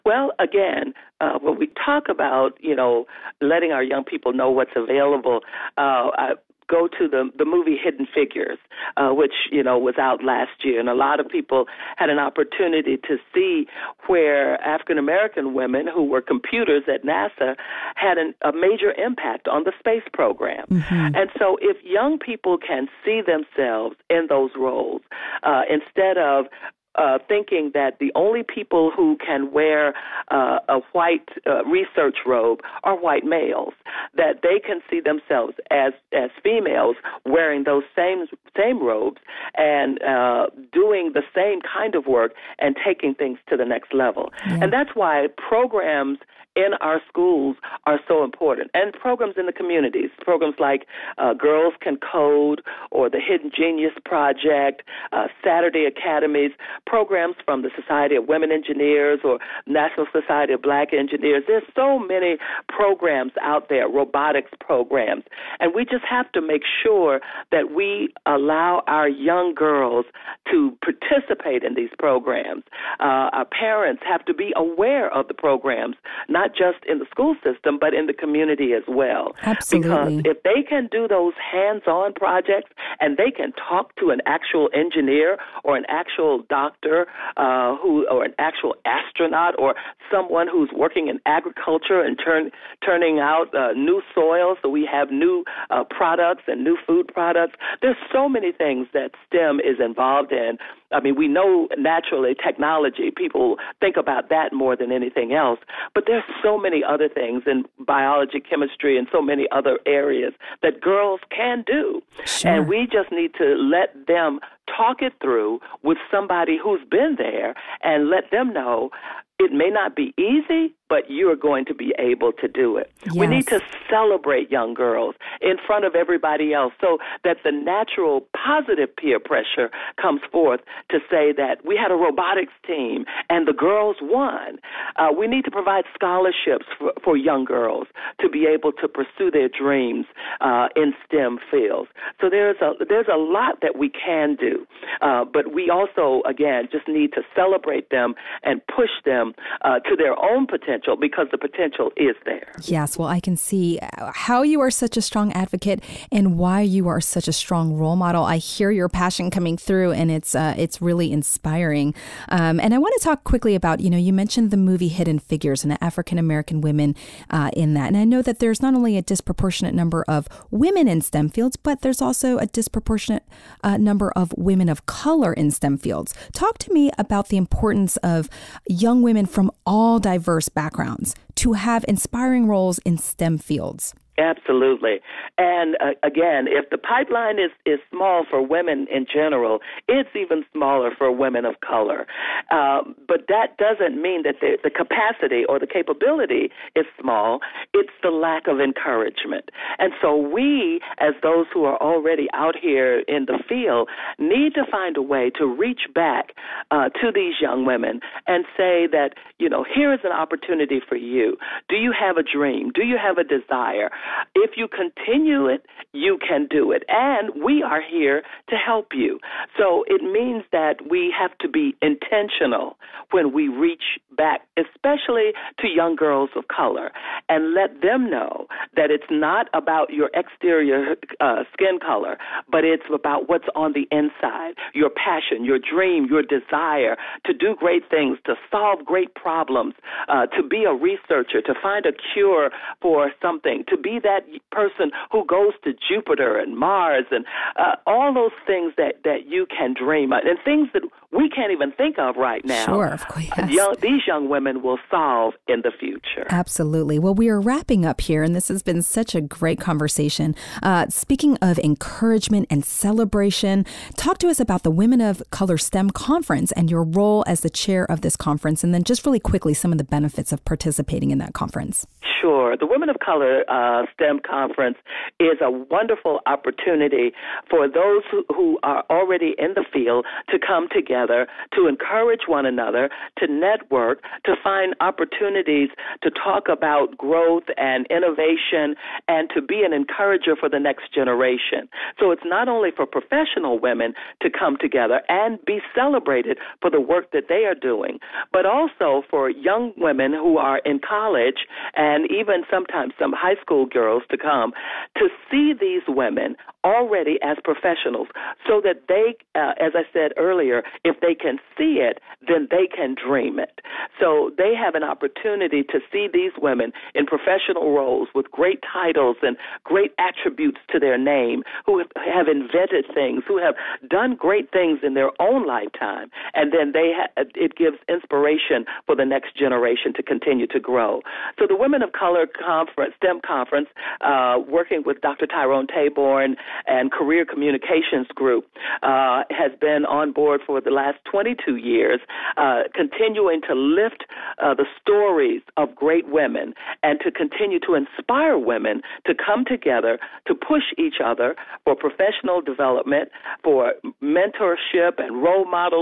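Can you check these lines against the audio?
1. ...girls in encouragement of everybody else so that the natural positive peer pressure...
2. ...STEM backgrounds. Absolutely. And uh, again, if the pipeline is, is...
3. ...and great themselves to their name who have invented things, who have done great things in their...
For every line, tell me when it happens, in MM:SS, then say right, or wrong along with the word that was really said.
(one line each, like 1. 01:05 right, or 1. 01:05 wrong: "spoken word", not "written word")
1. 02:04 wrong: "front", not "encouragement"
2. 03:02 wrong: "fields", not "backgrounds"
3. 05:19 wrong: "attributes", not "themselves".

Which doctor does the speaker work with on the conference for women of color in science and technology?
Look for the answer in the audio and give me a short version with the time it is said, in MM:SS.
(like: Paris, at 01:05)
Dr. Tyrone Taborn, at 05:35.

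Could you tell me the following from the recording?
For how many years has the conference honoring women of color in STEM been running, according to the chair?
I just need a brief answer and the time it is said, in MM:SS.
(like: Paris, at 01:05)
22, at 05:41.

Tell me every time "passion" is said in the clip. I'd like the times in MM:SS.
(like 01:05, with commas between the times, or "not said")
02:38, 03:54.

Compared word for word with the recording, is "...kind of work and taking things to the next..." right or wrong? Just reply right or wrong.
right.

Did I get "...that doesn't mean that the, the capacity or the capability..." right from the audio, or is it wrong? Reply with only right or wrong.
right.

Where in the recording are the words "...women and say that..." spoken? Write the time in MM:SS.
03:27.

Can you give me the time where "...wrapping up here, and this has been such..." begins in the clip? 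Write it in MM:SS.
04:17.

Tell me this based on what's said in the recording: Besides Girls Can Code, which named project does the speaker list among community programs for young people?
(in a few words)
Hidden Genius Project.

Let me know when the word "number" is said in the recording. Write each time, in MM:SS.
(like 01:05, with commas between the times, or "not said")
02:49, 02:53.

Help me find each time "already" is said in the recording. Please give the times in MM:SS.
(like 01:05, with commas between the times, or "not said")
03:21, 04:38, 05:06.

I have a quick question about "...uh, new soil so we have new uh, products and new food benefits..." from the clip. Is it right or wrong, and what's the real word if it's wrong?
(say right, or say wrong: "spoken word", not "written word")
wrong: "products", not "benefits".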